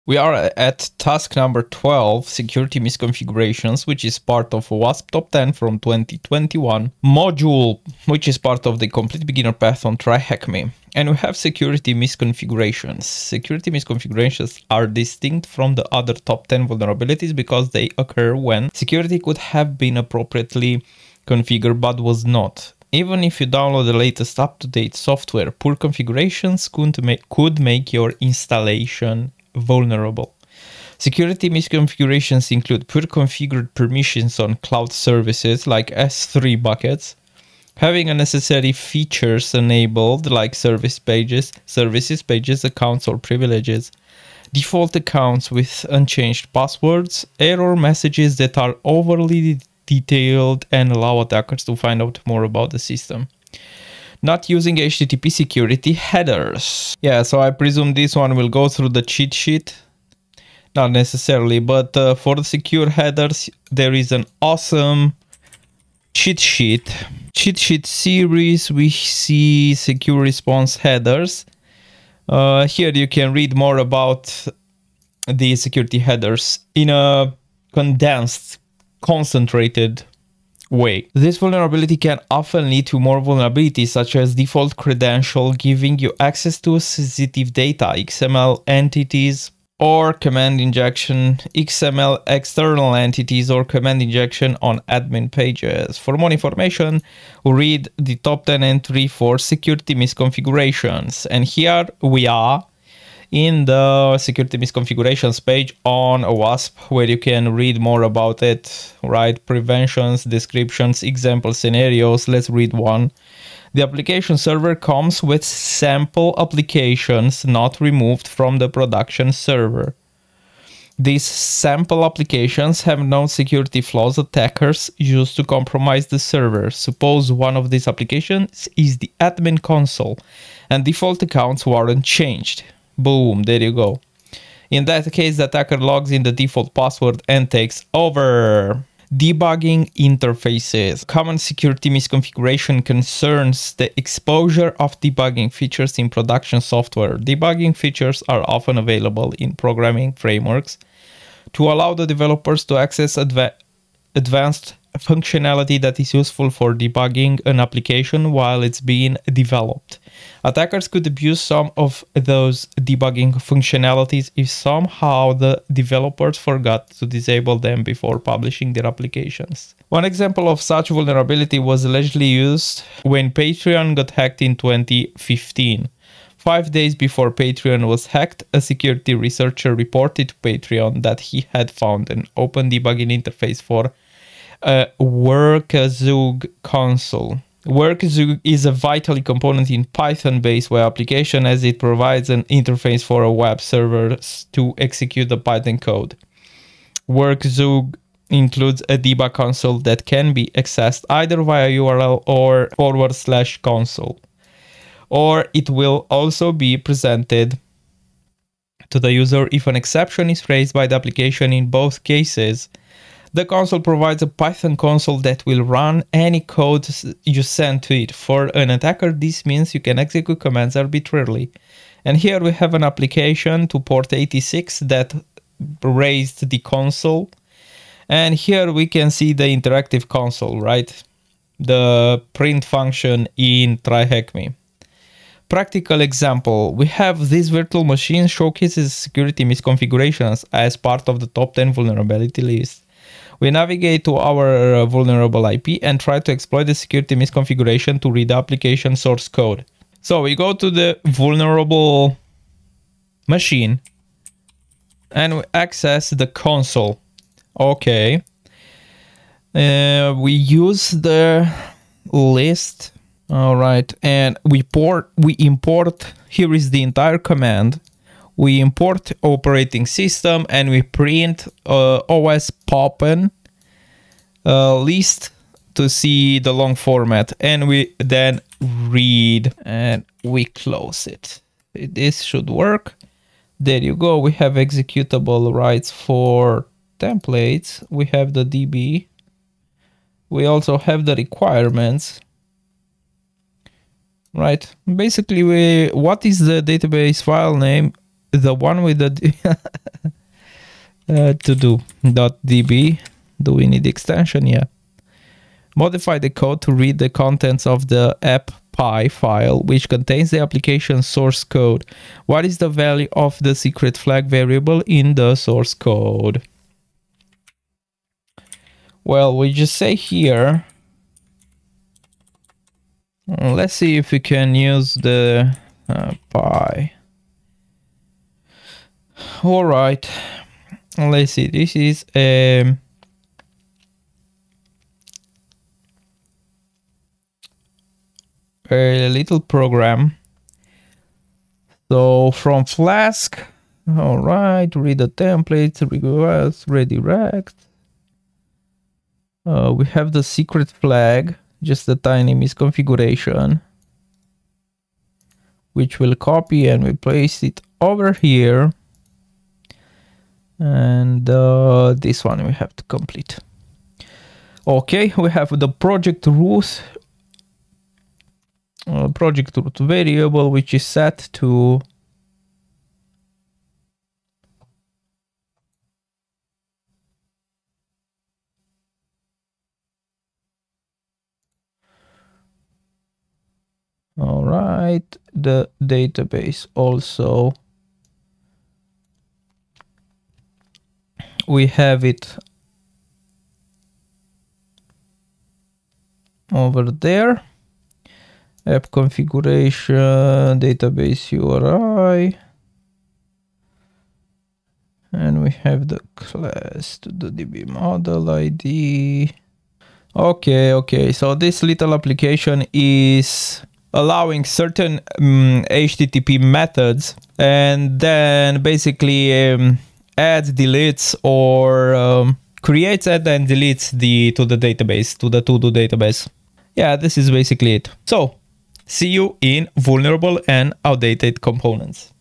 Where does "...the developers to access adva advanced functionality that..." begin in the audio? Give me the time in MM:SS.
02:31.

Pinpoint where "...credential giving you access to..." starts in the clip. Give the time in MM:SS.
01:24.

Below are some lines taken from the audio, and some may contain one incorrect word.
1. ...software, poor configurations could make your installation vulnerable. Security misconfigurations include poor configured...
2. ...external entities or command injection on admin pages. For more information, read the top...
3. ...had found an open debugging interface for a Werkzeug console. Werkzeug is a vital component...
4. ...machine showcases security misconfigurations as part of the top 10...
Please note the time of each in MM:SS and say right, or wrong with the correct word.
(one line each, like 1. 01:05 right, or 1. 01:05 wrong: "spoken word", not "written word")
1. 00:24 right
2. 01:32 right
3. 03:01 right
4. 03:57 right.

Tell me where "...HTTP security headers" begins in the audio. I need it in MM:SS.
00:54.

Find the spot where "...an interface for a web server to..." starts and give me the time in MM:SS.
03:12.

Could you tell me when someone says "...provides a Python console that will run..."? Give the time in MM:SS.
03:33.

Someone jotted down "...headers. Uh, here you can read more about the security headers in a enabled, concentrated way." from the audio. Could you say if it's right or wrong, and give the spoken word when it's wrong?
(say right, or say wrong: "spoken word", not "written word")
wrong: "condensed", not "enabled".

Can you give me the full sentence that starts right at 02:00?
These sample applications have known security flaws attackers use to compromise the server.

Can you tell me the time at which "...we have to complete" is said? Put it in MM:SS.
06:02.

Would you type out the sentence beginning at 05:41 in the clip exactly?
So from Flask, all right, read the templates, request, redirect.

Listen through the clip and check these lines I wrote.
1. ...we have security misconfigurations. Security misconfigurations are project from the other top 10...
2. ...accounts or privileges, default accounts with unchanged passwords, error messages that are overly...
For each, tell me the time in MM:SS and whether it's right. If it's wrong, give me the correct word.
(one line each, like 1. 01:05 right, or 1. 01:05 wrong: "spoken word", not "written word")
1. 00:11 wrong: "distinct", not "project"
2. 00:42 right.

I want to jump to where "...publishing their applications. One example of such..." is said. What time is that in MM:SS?
02:48.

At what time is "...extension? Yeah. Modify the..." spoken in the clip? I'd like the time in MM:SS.
05:03.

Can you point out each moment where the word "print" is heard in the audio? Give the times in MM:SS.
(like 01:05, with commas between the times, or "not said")
03:52, 04:30.